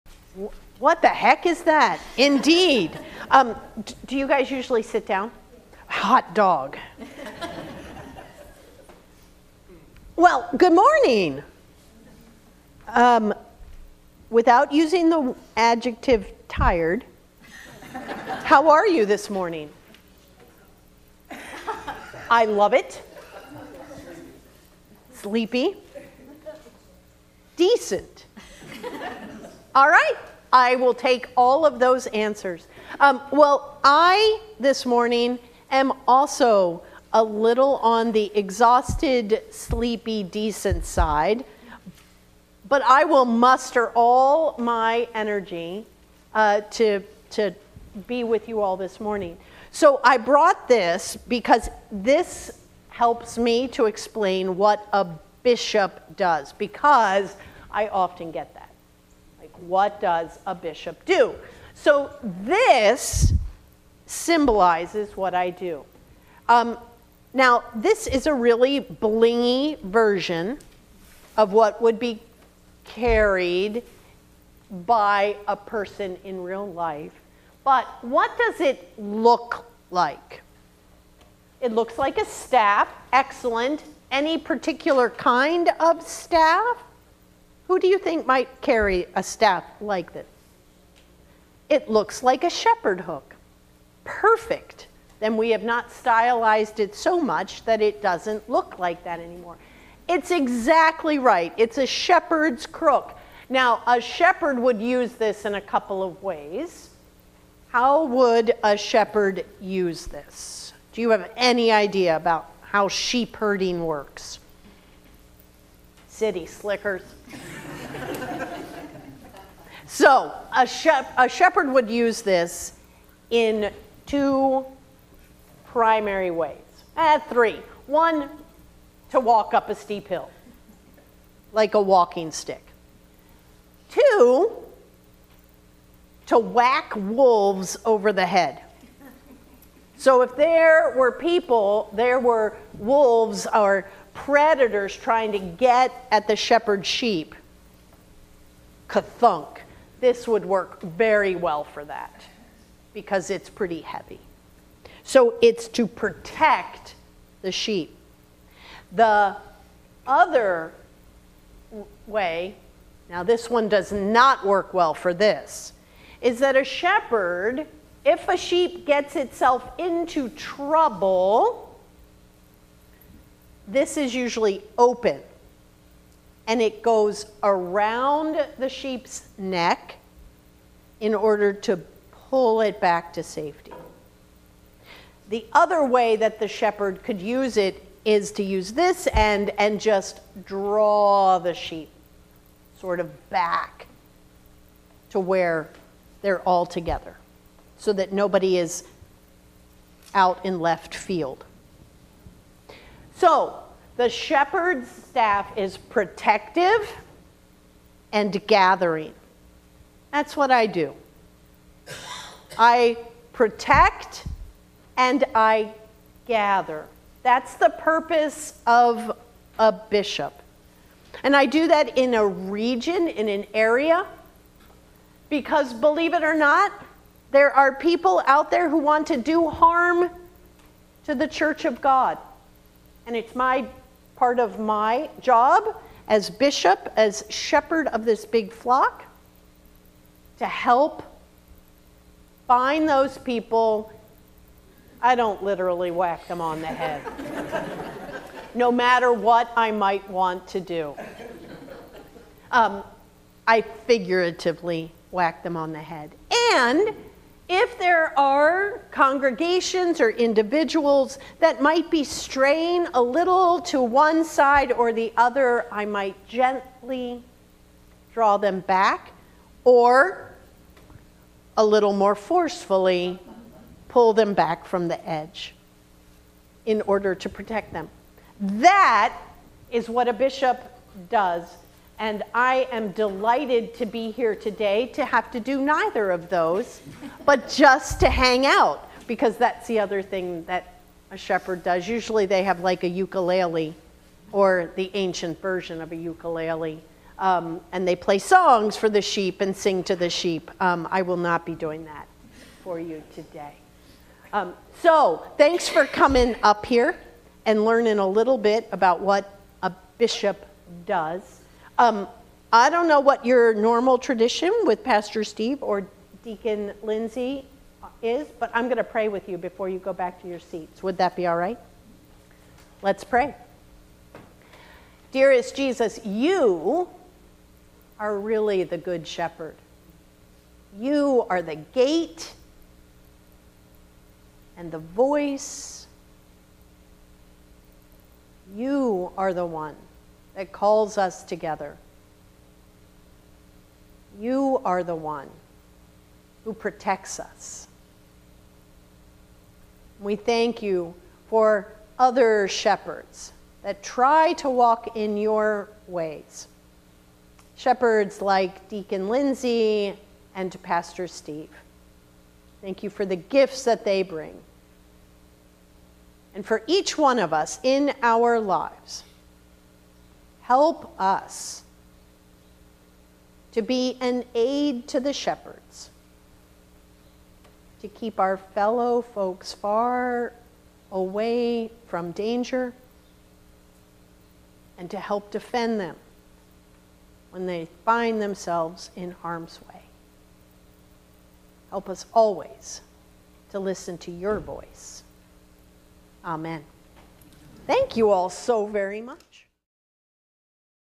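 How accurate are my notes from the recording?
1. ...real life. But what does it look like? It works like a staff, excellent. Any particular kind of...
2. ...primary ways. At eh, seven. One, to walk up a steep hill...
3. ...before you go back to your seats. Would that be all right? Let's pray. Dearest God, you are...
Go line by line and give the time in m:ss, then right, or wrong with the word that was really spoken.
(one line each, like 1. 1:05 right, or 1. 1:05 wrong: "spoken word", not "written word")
1. 1:16 wrong: "looks", not "works"
2. 2:05 wrong: "three", not "seven"
3. 5:19 wrong: "Jesus", not "God".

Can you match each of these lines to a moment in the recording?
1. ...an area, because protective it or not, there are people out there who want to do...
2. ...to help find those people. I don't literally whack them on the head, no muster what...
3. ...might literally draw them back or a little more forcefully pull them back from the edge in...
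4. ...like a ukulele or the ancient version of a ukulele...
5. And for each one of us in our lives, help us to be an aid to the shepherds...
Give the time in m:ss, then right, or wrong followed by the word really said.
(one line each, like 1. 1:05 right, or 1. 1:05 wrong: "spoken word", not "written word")
1. 3:43 wrong: "believe", not "protective"
2. 4:00 wrong: "matter", not "muster"
3. 4:25 wrong: "gently", not "literally"
4. 4:52 right
5. 6:06 right.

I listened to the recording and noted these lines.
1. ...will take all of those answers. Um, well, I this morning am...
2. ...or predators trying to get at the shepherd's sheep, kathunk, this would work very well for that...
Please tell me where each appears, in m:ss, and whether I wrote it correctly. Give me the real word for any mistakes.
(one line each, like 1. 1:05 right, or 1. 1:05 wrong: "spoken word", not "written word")
1. 0:30 right
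2. 2:23 right.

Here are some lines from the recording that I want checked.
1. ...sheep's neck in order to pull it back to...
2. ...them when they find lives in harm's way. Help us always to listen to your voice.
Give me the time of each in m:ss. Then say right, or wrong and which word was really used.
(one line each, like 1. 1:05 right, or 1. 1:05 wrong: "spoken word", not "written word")
1. 2:58 right
2. 6:25 wrong: "themselves", not "lives".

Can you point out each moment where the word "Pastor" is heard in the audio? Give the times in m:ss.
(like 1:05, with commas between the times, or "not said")
5:14, 6:00.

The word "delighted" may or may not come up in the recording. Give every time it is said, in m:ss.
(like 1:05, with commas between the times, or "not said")
4:42.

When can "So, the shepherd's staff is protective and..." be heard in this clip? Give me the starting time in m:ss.
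3:23.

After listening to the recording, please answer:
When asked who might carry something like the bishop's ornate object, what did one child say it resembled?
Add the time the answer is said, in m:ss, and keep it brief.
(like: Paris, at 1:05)
A shepherd hook, at 1:32.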